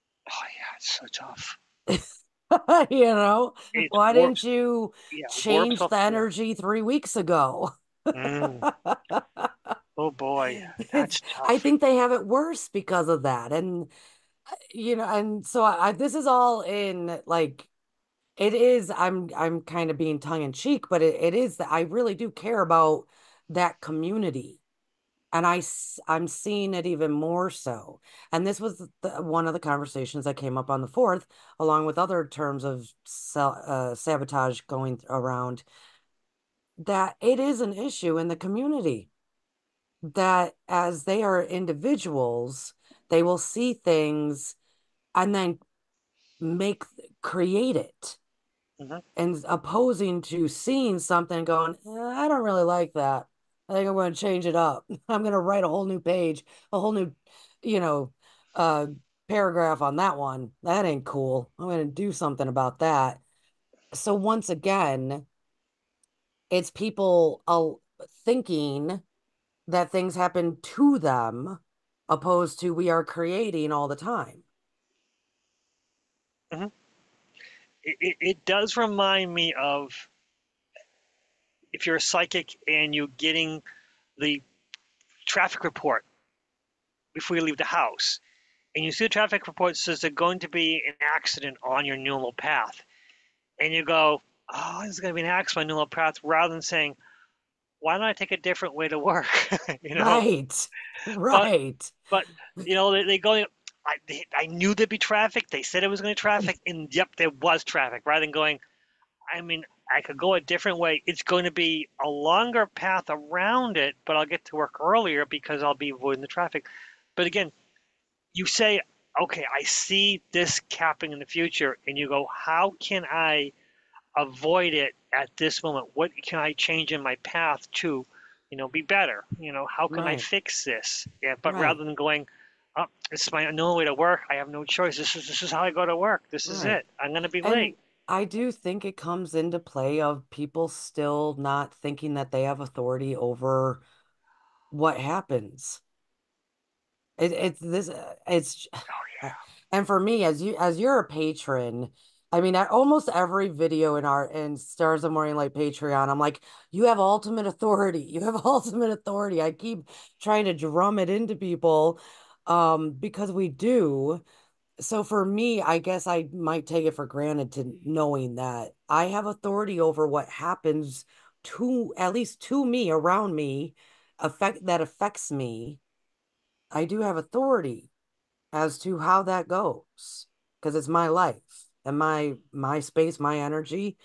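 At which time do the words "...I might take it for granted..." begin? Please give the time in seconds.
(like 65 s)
166 s.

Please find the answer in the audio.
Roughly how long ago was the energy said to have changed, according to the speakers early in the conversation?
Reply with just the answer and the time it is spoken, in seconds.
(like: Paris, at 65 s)
3 weeks ago, at 6 s.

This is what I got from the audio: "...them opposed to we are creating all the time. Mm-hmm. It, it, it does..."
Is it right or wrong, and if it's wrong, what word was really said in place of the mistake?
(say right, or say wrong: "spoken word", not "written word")
right.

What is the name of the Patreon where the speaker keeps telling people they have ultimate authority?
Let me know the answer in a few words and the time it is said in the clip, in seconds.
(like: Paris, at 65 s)
Stars of Morning Light, at 154 s.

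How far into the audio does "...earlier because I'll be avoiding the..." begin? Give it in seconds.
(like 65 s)
114 s.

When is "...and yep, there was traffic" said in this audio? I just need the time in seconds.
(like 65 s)
106 s.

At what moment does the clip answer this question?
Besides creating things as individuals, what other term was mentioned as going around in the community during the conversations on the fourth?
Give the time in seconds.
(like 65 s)
33 s.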